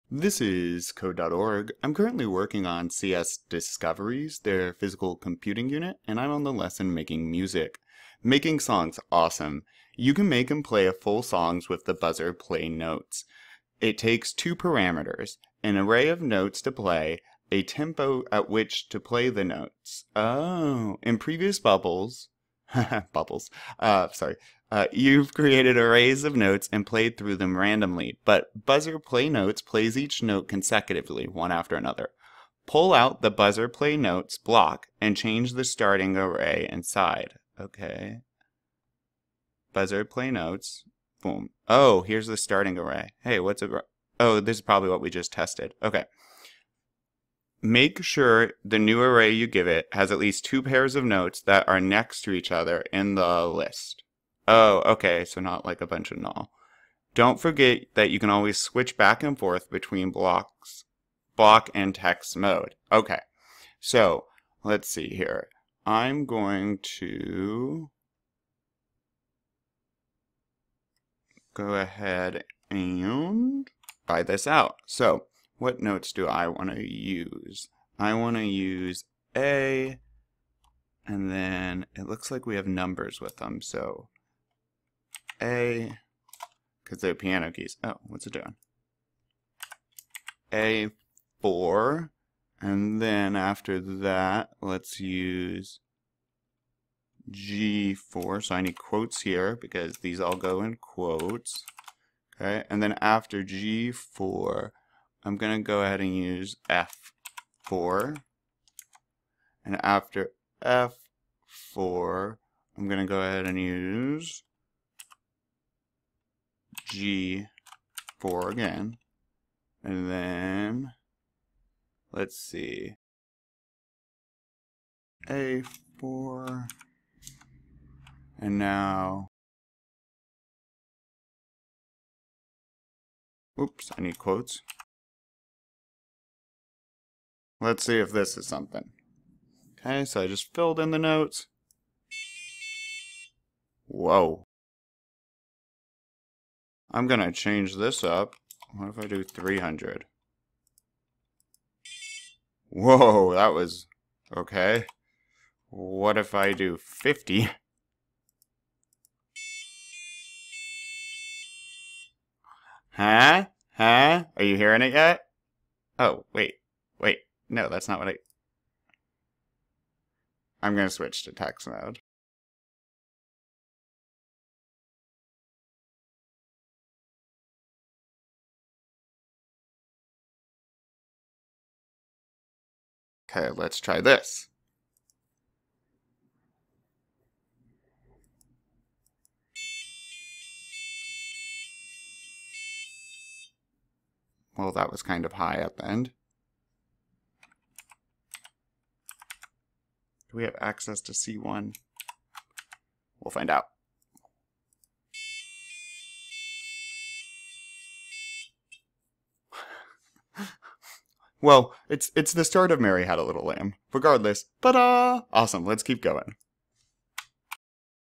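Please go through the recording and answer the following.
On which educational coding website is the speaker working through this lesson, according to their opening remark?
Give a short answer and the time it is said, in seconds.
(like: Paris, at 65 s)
code.org, at 0 s.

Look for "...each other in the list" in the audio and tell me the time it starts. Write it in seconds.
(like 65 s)
52 s.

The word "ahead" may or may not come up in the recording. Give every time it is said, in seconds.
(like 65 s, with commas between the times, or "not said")
71 s, 105 s, 113 s.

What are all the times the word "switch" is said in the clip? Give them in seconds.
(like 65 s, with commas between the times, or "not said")
58 s, 170 s.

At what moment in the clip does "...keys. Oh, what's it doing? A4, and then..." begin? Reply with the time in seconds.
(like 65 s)
87 s.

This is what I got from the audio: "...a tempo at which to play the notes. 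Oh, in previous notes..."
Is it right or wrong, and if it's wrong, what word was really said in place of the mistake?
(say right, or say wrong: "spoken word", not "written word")
wrong: "bubbles", not "notes".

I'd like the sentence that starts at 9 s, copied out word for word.
You can make and play full songs with the buzzer play notes.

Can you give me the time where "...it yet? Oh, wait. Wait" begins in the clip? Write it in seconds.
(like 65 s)
164 s.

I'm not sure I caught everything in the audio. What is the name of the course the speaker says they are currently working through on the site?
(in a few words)
CS Discoveries.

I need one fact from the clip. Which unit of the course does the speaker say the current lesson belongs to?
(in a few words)
physical computing.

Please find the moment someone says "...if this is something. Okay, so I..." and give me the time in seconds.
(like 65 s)
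137 s.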